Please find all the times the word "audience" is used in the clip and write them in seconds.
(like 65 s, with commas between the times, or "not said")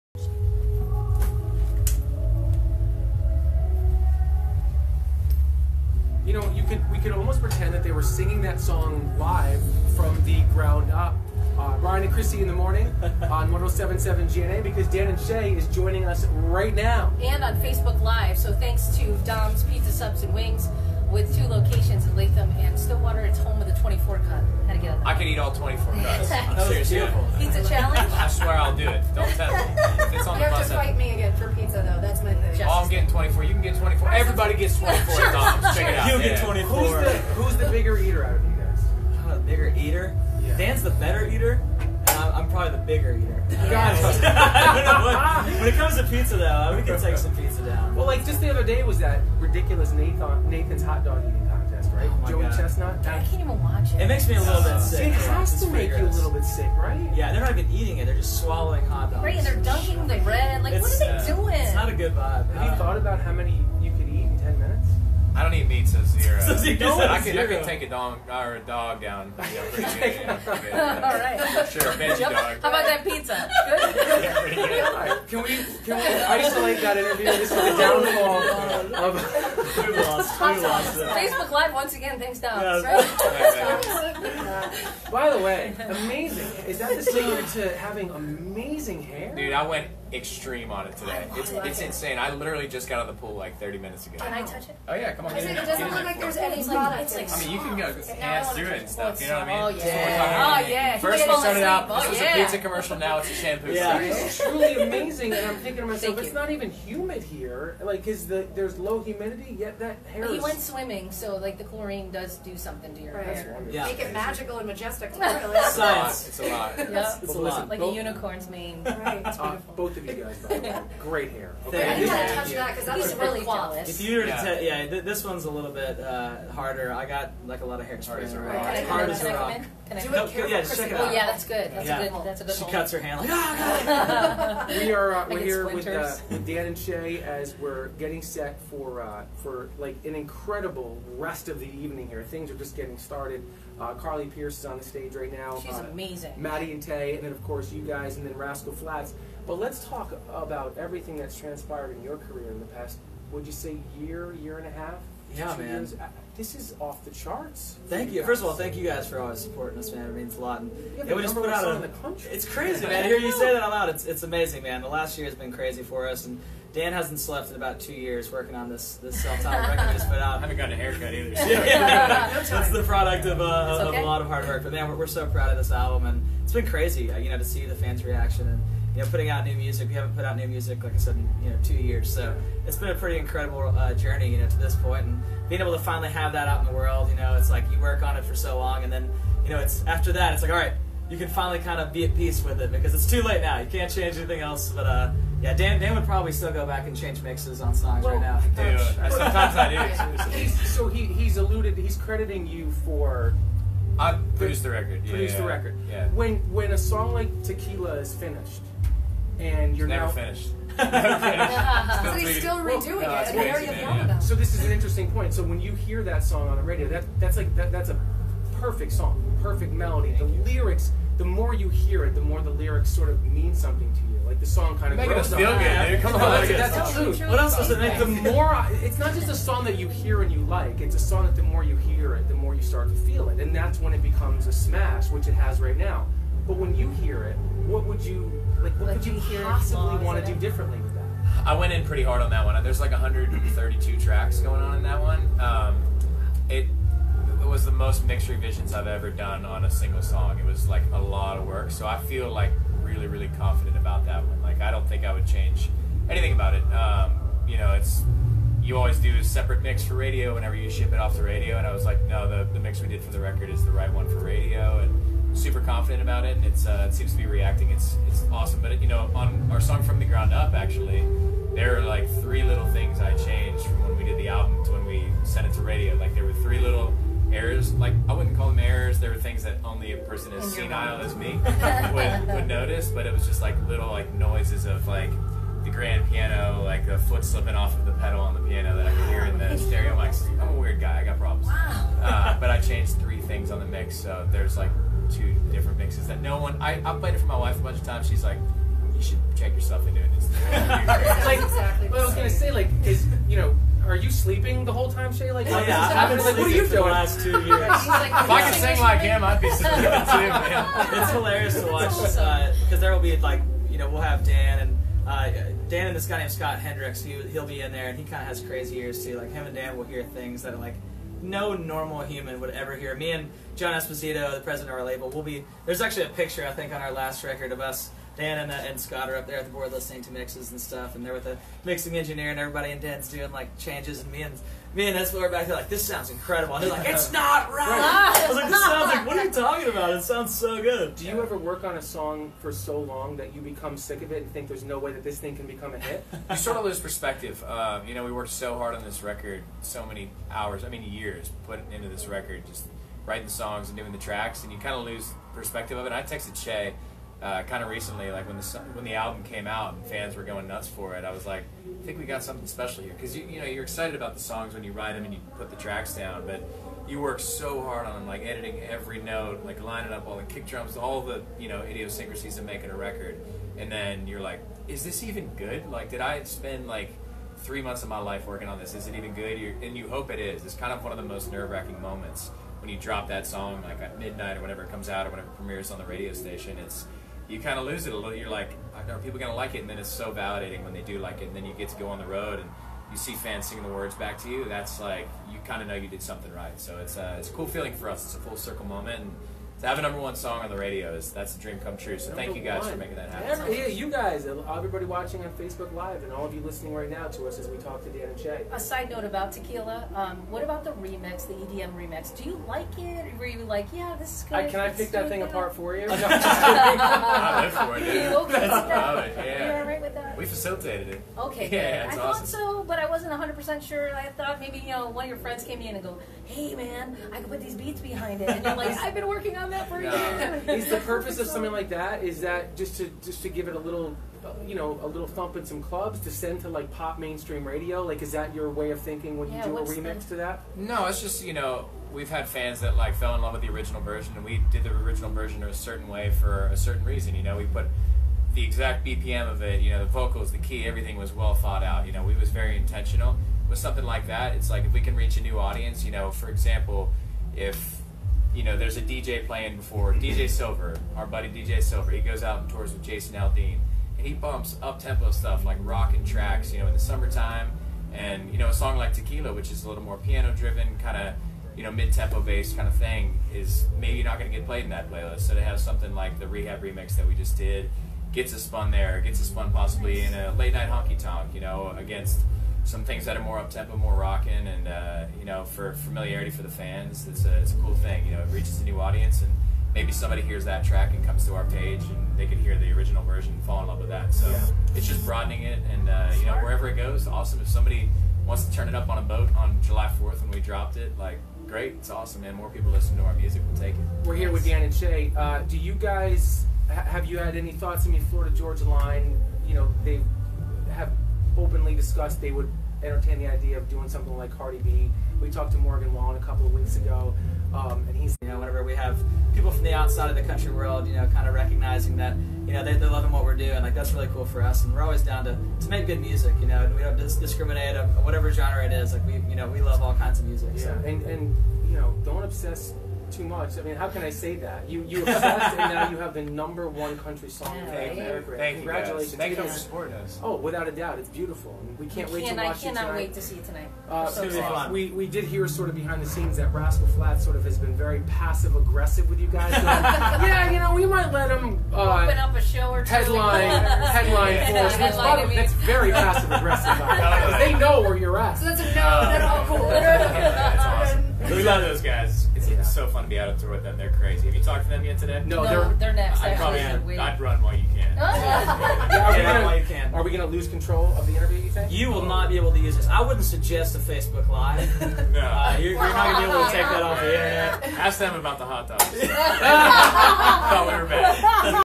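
455 s, 488 s.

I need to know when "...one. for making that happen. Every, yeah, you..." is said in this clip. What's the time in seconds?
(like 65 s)
402 s.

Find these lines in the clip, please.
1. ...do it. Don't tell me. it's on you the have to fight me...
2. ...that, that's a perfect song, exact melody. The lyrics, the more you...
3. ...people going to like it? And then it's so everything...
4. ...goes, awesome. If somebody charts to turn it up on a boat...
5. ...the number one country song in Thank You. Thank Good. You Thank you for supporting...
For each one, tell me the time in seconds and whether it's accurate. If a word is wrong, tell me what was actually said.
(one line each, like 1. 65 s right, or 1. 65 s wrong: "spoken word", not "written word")
1. 28 s right
2. 217 s wrong: "perfect", not "exact"
3. 388 s wrong: "validating", not "everything"
4. 496 s wrong: "wants", not "charts"
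5. 536 s wrong: "Congratulations", not "Good".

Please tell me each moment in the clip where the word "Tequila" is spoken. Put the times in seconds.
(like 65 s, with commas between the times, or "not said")
207 s, 409 s, 468 s.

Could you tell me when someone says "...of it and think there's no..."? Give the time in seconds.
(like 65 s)
344 s.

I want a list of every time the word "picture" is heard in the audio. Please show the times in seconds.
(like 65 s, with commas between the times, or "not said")
326 s.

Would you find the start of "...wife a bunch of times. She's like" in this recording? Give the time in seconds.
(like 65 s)
297 s.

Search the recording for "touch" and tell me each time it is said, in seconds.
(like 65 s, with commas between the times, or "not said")
94 s, 122 s.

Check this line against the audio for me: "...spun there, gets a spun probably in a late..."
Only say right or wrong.
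wrong.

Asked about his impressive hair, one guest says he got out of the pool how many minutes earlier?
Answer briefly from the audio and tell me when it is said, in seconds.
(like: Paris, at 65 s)
30, at 93 s.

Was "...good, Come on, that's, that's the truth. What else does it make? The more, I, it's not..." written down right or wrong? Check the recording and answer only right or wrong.
right.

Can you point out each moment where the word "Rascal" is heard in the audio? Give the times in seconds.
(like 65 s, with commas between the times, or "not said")
148 s, 546 s.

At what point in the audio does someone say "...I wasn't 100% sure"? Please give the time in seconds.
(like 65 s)
422 s.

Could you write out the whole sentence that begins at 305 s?
Like, oh, yeah, yeah I haven't like, what are you doing?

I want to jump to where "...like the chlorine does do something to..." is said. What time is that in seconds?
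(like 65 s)
111 s.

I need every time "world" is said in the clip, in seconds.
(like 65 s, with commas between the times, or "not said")
186 s, 520 s.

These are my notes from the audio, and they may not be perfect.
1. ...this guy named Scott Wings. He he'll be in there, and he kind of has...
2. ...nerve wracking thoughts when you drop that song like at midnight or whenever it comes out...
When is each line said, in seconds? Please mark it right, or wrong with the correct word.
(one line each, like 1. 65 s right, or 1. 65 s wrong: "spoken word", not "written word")
1. 315 s wrong: "Hendricks", not "Wings"
2. 381 s wrong: "moments", not "thoughts".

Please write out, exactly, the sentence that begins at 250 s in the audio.
It was like a lot of work, so I feel like really, really confident about that one.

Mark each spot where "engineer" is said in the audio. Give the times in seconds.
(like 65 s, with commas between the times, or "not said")
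331 s.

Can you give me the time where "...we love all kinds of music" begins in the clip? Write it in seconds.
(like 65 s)
529 s.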